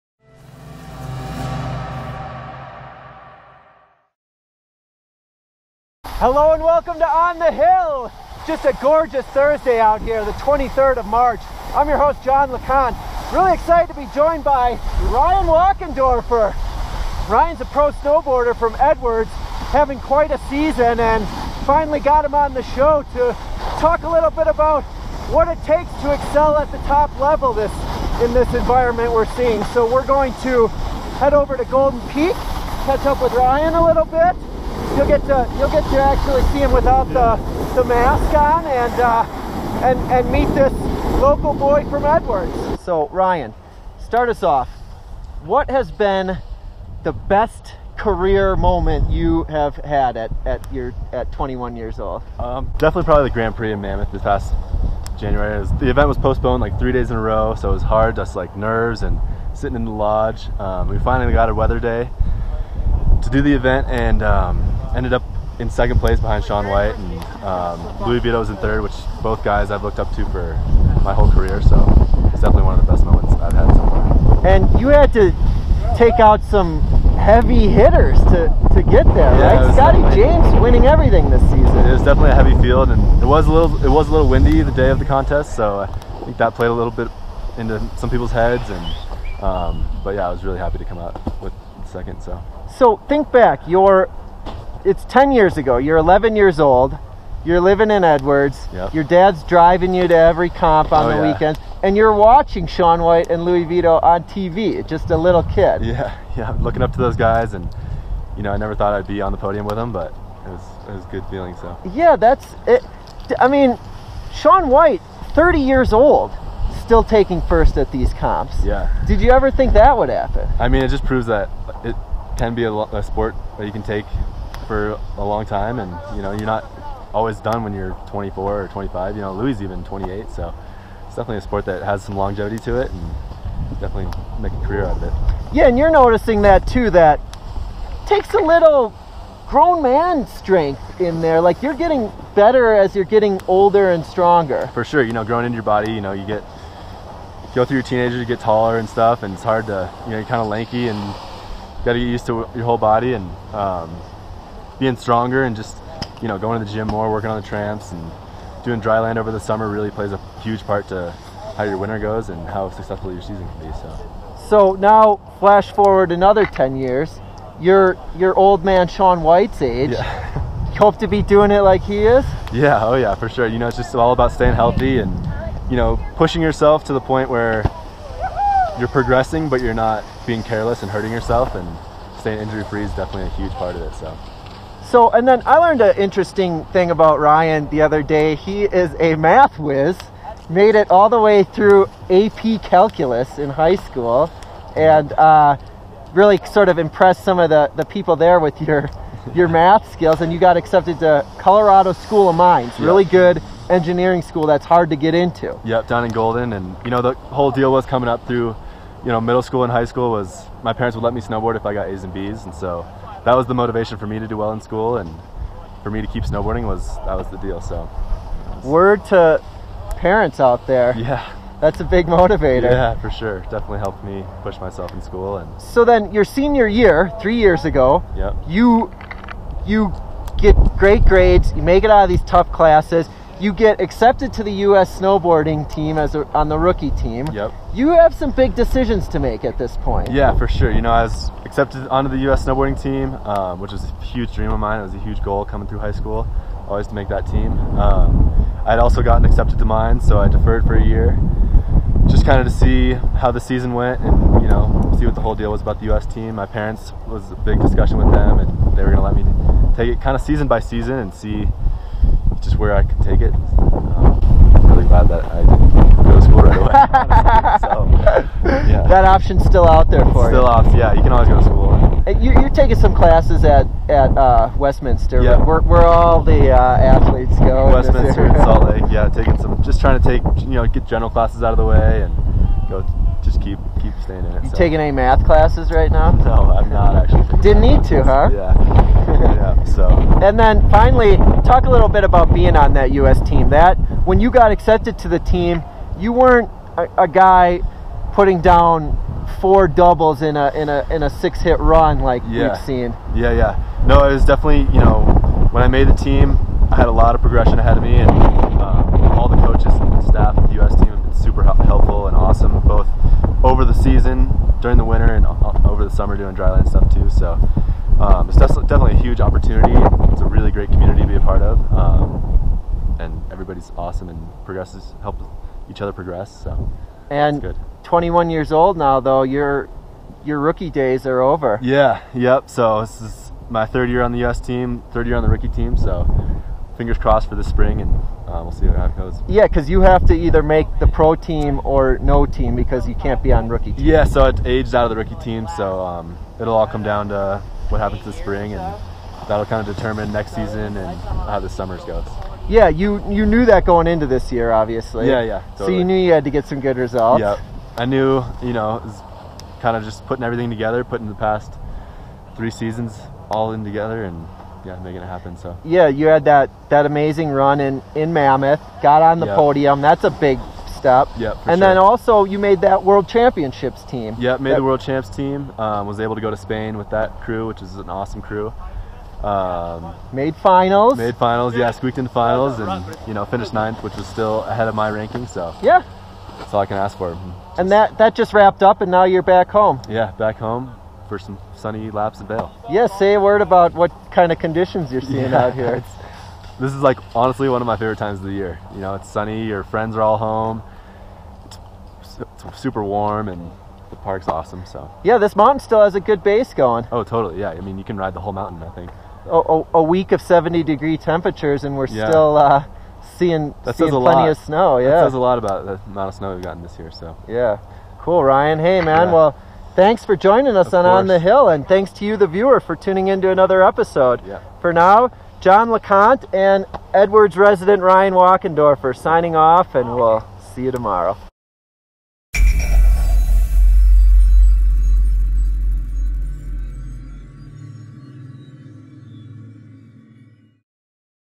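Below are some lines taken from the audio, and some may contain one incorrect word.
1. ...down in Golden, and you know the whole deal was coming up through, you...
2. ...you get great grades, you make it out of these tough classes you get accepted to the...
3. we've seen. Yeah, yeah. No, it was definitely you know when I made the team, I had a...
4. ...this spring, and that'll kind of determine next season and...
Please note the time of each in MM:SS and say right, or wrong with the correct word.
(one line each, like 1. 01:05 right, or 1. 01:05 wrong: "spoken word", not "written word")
1. 03:25 right
2. 03:49 right
3. 05:02 right
4. 05:48 right.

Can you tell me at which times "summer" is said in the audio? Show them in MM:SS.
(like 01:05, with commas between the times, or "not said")
02:39, 05:15, 05:51.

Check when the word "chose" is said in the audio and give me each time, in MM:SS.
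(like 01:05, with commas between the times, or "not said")
not said.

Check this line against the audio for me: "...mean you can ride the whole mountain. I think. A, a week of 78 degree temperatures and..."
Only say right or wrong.
wrong.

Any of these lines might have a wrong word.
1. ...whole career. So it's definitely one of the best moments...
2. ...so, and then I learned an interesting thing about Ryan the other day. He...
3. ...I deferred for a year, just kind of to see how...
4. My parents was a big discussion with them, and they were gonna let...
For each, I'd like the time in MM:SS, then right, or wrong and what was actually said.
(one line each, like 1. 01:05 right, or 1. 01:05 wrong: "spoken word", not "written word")
1. 01:11 right
2. 03:04 right
3. 04:10 right
4. 04:16 right.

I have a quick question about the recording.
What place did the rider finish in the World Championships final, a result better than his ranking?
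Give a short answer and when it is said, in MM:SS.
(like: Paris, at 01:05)
9th, at 06:23.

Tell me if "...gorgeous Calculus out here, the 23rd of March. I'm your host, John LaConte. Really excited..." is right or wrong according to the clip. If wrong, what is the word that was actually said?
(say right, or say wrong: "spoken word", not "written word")
wrong: "Thursday", not "Calculus".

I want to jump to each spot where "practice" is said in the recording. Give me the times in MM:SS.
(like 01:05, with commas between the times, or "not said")
not said.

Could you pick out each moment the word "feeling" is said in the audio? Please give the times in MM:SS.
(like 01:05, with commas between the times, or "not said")
01:51.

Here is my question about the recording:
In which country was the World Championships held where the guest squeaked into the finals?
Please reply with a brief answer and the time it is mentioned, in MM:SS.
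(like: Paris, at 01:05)
Spain, at 06:16.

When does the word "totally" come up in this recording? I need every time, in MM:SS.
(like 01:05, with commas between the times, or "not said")
05:55, 06:47.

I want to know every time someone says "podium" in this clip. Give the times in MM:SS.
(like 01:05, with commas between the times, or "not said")
01:49, 06:09.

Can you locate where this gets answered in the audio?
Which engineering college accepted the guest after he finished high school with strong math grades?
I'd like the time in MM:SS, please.
03:21.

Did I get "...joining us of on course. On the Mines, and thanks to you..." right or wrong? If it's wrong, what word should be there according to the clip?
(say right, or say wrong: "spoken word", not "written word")
wrong: "Hill", not "Mines".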